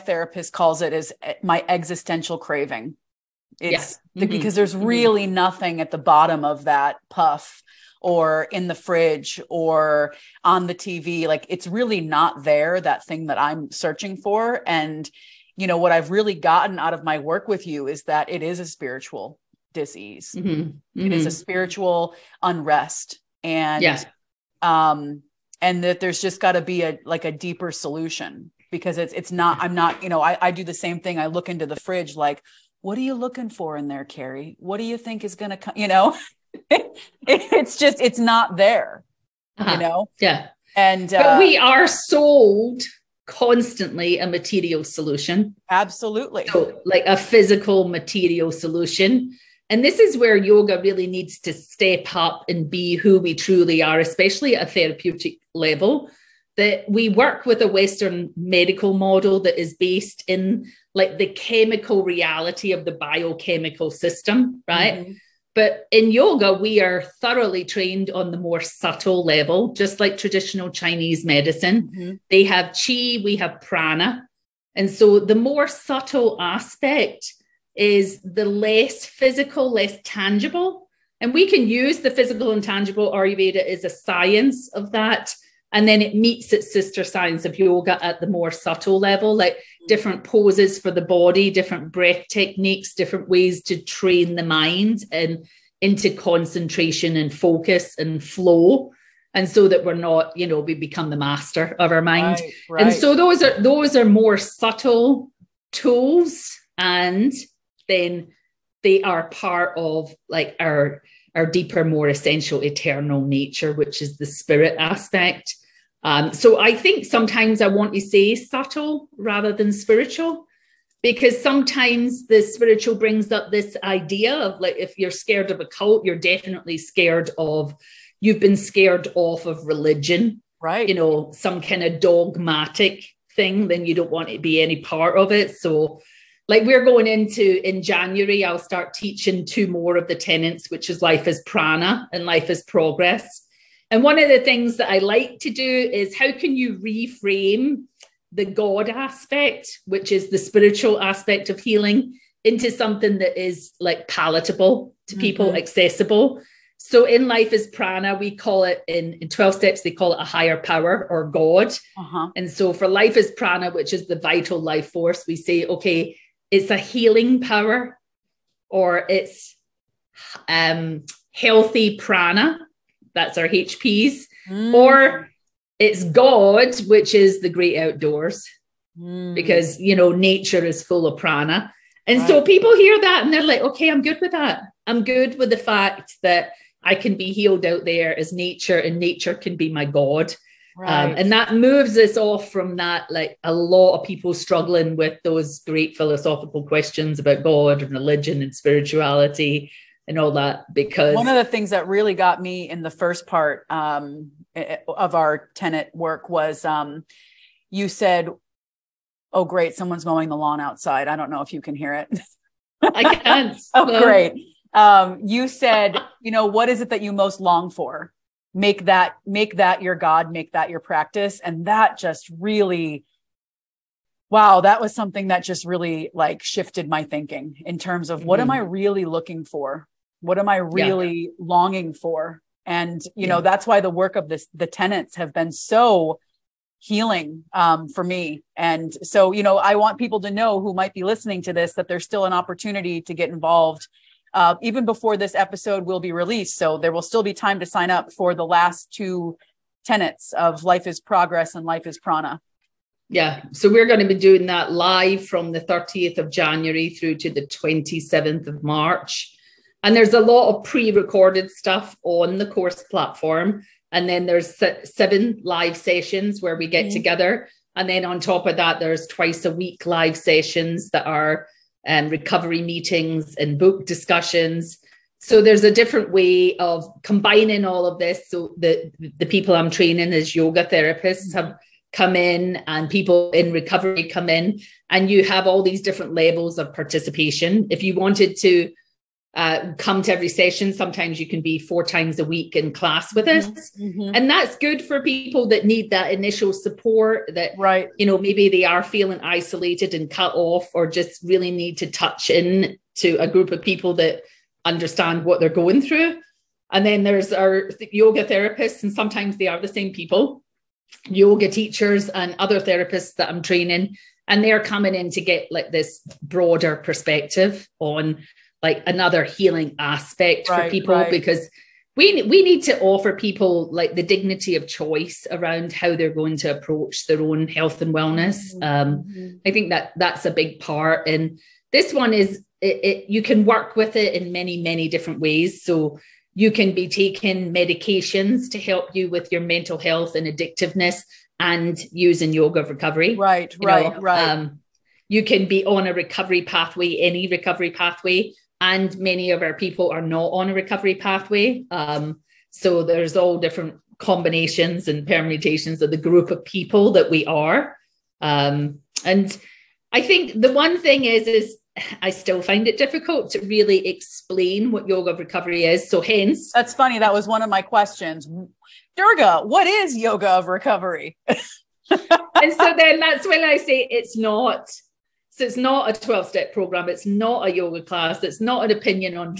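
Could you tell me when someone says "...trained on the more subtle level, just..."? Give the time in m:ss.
1:07.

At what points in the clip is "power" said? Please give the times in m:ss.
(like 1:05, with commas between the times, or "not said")
2:40, 2:47.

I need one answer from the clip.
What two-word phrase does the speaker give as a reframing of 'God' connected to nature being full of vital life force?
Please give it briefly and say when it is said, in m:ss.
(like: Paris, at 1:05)
great outdoors, at 2:57.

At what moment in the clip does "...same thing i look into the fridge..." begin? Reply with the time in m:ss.
0:30.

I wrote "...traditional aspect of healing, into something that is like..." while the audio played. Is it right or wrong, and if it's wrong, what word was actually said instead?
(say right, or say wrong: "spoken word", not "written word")
wrong: "spiritual", not "traditional".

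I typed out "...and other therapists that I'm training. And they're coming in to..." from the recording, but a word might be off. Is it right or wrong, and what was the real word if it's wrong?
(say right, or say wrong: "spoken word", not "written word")
right.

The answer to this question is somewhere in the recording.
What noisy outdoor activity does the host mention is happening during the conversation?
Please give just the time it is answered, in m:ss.
3:30.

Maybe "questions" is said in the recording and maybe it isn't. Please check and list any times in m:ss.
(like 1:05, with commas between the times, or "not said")
3:16, 6:07.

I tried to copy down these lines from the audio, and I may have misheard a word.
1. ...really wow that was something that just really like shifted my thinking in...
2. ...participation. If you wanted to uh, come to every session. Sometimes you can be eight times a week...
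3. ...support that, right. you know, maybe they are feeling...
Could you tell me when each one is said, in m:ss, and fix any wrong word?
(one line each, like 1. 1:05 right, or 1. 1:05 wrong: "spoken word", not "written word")
1. 3:42 right
2. 4:46 wrong: "four", not "eight"
3. 4:56 right.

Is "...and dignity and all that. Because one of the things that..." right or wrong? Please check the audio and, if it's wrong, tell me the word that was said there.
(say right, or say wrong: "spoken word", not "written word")
wrong: "spirituality", not "dignity".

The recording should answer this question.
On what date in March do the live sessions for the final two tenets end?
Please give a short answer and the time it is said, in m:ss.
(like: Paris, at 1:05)
27th of March, at 4:17.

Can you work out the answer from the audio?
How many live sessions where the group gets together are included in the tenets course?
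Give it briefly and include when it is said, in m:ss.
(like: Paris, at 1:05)
7, at 4:24.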